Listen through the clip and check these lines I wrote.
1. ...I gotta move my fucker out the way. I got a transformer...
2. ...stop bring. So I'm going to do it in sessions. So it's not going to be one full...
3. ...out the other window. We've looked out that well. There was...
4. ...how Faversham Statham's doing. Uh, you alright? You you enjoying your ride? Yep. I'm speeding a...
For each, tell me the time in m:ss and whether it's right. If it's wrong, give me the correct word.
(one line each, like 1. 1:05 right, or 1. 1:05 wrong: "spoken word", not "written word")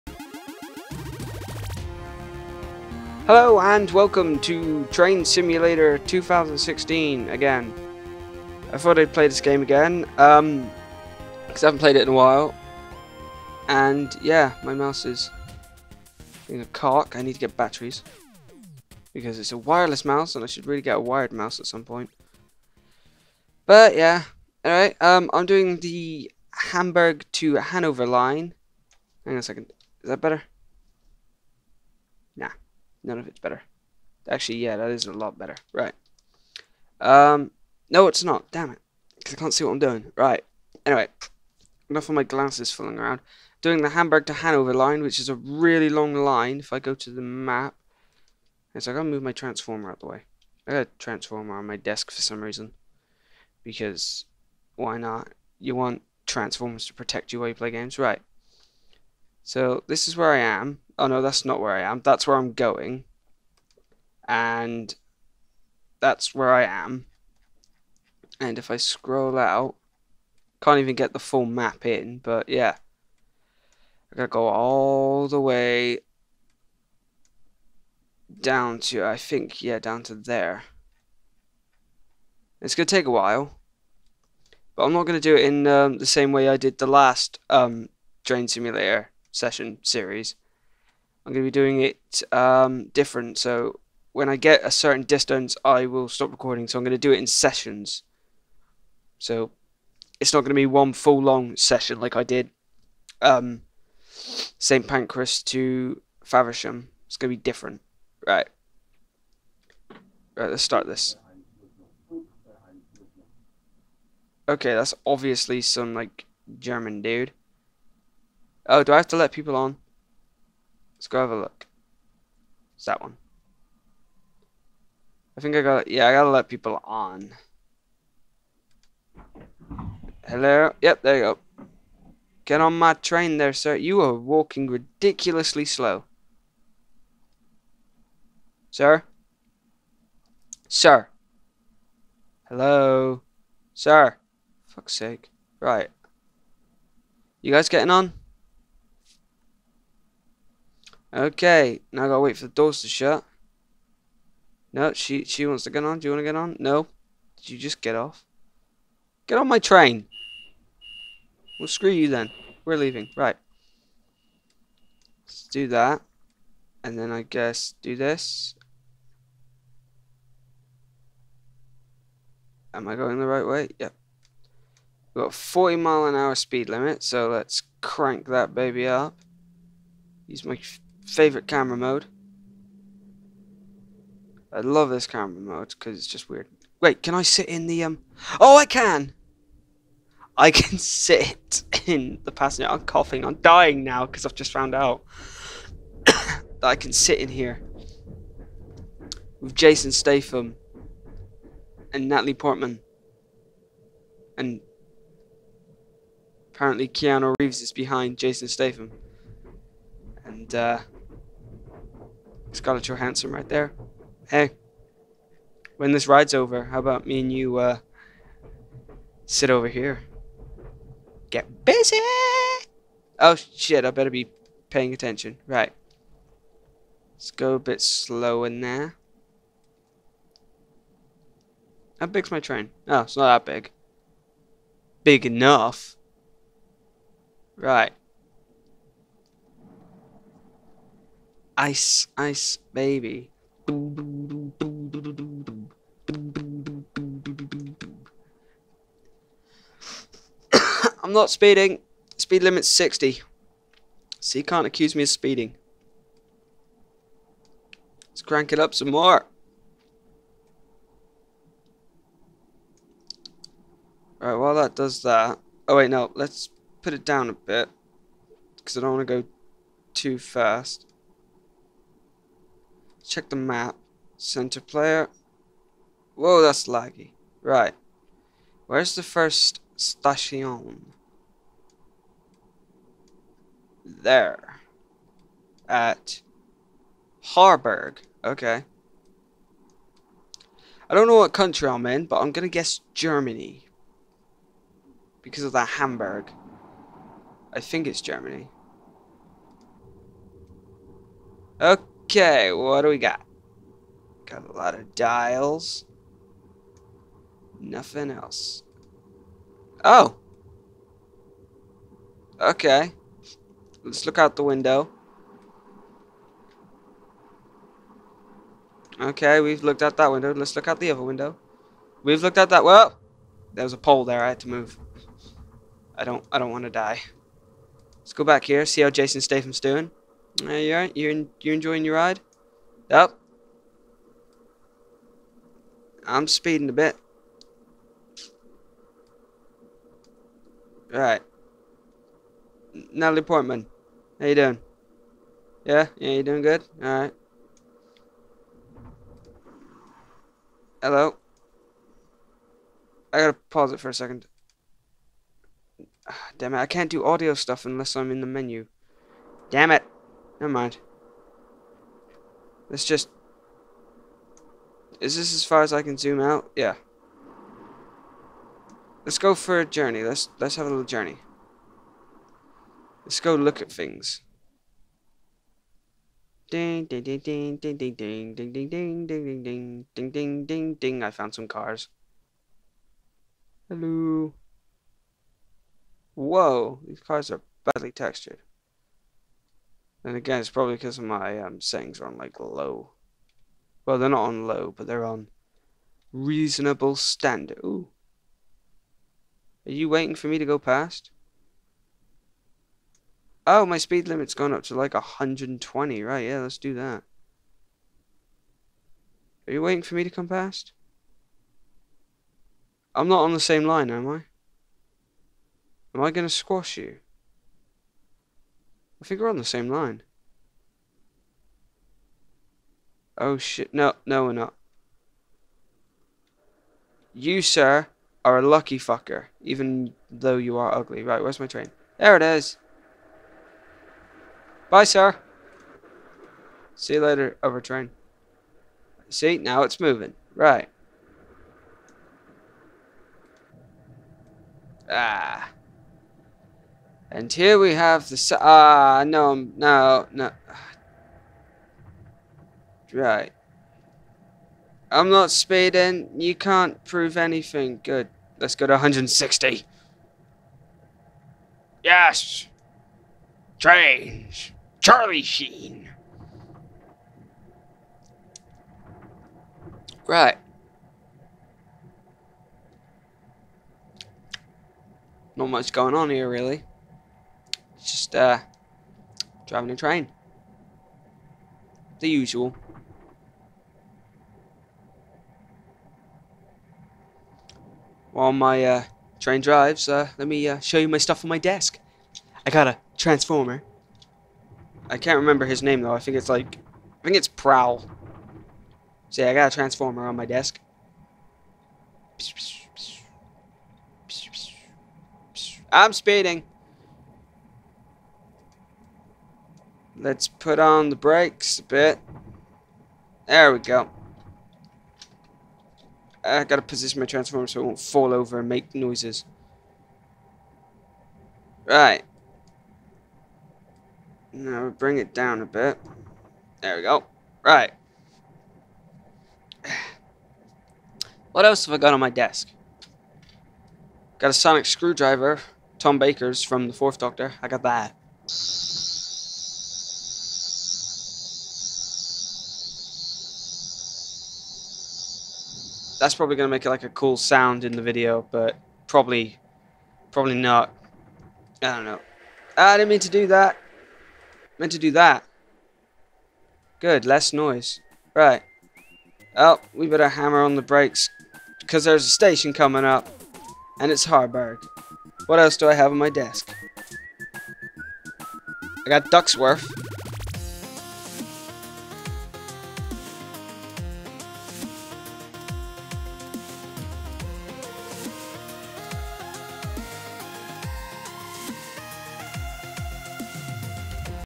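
1. 0:48 wrong: "transformer", not "fucker"
2. 1:36 wrong: "recording", not "bring"
3. 5:20 right
4. 5:28 wrong: "Jason", not "Faversham".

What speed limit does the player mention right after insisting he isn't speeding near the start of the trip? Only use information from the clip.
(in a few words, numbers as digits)
60.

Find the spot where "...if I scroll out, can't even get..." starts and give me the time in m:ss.
1:08.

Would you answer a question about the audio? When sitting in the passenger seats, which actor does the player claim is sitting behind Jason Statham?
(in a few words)
Keanu Reeves.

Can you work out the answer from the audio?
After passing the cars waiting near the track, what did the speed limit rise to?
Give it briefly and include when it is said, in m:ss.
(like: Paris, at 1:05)
120, at 6:44.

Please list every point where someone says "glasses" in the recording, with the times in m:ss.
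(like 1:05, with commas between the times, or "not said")
0:42.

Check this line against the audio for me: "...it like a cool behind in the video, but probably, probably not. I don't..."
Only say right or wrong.
wrong.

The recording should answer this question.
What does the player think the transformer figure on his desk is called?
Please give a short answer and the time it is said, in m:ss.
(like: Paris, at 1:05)
Prowl, at 8:17.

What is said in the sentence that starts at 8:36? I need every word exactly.
I gotta position my transformer so it won't fall over and make noises.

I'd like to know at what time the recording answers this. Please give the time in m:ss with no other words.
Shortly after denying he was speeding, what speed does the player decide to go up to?
7:38.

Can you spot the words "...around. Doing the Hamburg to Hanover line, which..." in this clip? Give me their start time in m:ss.
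0:42.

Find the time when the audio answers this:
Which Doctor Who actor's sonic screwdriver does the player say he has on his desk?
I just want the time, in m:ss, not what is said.
8:55.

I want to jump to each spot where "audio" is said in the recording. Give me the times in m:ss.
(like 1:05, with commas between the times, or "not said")
5:57.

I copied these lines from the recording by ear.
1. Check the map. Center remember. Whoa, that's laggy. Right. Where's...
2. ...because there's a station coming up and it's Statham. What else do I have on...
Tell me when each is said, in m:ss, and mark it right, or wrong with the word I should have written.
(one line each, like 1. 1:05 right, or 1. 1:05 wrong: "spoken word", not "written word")
1. 4:33 wrong: "player", not "remember"
2. 9:21 wrong: "Harburg", not "Statham".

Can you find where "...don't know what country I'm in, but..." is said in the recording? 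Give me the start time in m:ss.
4:50.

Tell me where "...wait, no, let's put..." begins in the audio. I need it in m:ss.
4:25.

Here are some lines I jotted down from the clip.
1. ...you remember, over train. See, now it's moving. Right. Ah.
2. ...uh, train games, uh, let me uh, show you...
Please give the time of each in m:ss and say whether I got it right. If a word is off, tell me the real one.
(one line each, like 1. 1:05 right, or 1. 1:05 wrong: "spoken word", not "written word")
1. 7:16 wrong: "later", not "remember"
2. 8:08 wrong: "drives", not "games".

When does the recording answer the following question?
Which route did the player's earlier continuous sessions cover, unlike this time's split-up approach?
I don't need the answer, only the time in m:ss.
1:44.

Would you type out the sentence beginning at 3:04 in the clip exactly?
I love this camera mode because it's just weird.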